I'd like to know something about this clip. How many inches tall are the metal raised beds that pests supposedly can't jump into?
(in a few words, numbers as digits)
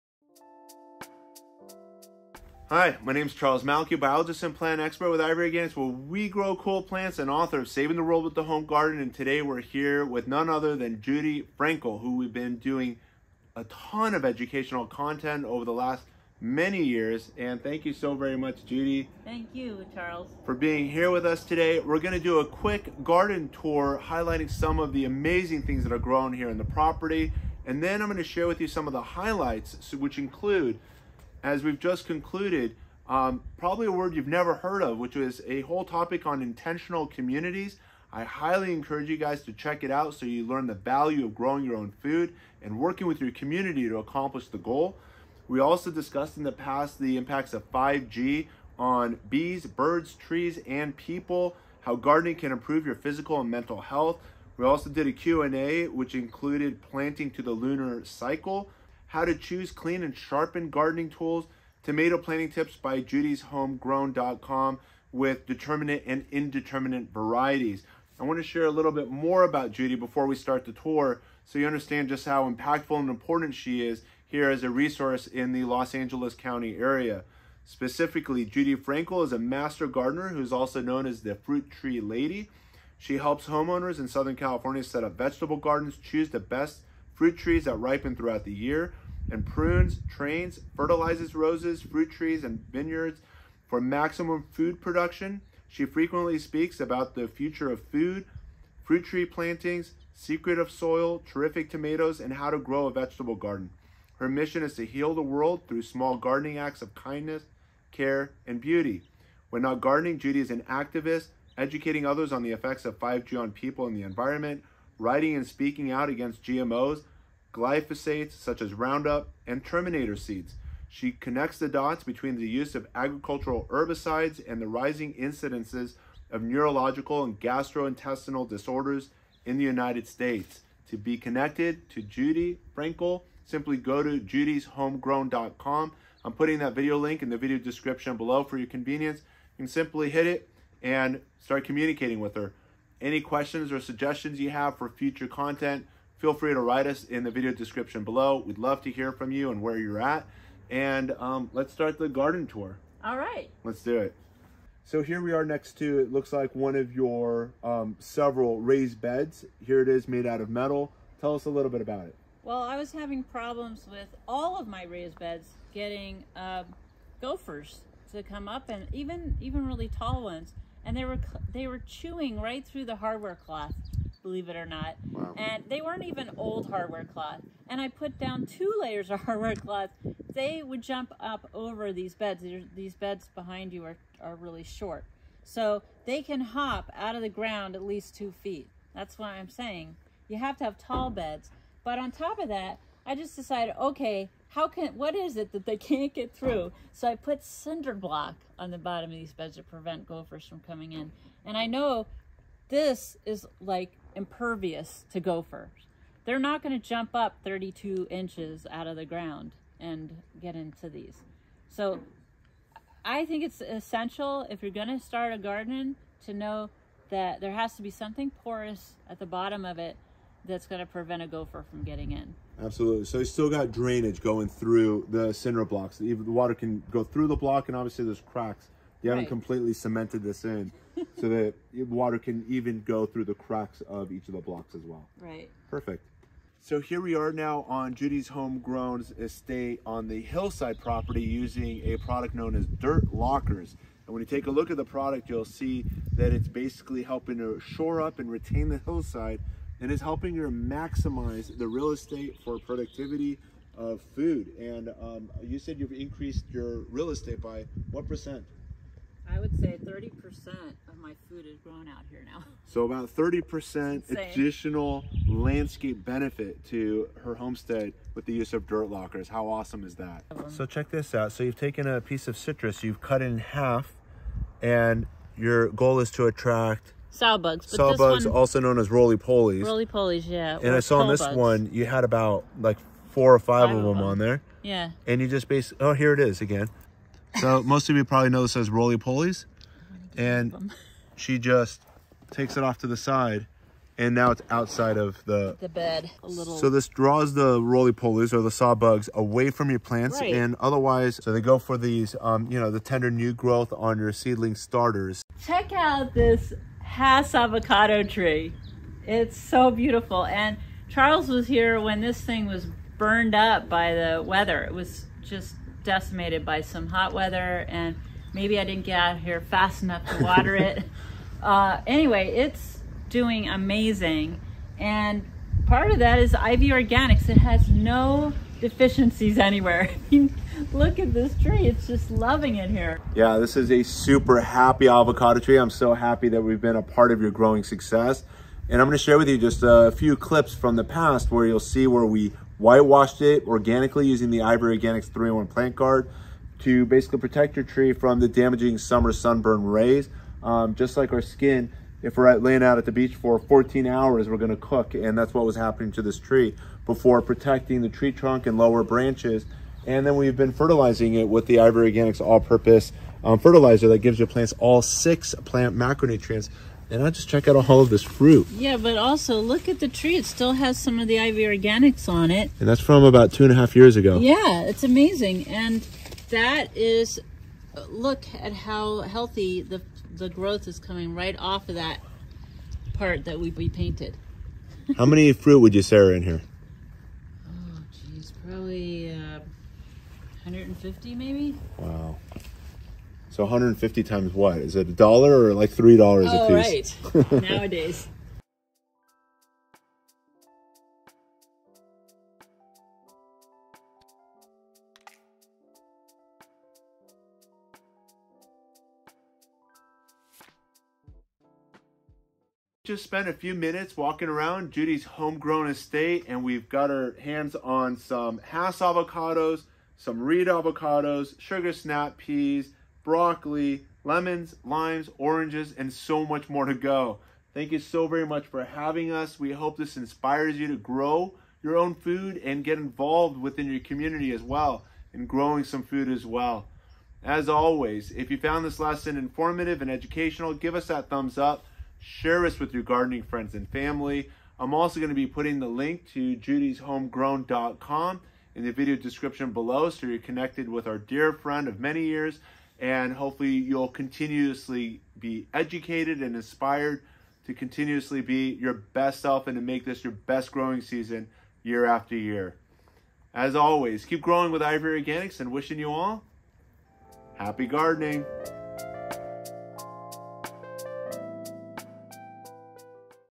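32.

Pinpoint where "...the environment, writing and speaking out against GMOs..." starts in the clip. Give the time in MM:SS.
01:53.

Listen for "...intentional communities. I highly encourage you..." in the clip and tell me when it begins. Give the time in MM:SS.
00:36.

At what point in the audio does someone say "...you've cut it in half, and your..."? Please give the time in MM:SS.
04:32.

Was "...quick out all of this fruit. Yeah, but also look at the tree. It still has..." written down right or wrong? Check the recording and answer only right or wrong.
wrong.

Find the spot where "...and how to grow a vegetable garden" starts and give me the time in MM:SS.
01:42.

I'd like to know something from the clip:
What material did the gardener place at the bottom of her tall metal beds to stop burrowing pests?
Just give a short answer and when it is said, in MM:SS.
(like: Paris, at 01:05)
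Cinder block, at 03:17.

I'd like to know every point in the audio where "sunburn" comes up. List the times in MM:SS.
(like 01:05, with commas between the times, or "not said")
05:49.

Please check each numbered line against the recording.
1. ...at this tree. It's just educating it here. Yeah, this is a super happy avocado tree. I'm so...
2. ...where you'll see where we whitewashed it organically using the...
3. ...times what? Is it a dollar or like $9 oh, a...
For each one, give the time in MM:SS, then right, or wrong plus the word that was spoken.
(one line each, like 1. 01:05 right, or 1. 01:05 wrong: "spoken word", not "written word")
1. 05:30 wrong: "loving", not "educating"
2. 05:41 right
3. 06:34 wrong: "3", not "9".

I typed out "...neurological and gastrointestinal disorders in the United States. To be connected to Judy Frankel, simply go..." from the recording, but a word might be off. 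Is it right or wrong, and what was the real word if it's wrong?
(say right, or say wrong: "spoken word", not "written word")
right.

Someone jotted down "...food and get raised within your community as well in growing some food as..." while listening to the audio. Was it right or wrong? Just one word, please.
wrong.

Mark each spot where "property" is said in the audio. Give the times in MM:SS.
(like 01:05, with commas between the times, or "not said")
00:26, 04:00.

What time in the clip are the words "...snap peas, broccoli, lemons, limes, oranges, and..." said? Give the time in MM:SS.
07:01.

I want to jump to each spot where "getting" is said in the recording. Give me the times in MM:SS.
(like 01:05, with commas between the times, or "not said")
02:45, 03:41.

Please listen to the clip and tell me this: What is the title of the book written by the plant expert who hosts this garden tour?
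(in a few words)
Saving the World with the Home Garden.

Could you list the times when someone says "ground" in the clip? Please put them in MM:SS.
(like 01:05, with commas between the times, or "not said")
03:07, 03:29.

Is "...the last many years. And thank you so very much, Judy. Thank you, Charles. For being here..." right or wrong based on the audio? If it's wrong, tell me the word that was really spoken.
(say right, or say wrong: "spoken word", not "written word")
right.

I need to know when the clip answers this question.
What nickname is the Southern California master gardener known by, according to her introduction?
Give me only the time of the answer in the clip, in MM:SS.
01:21.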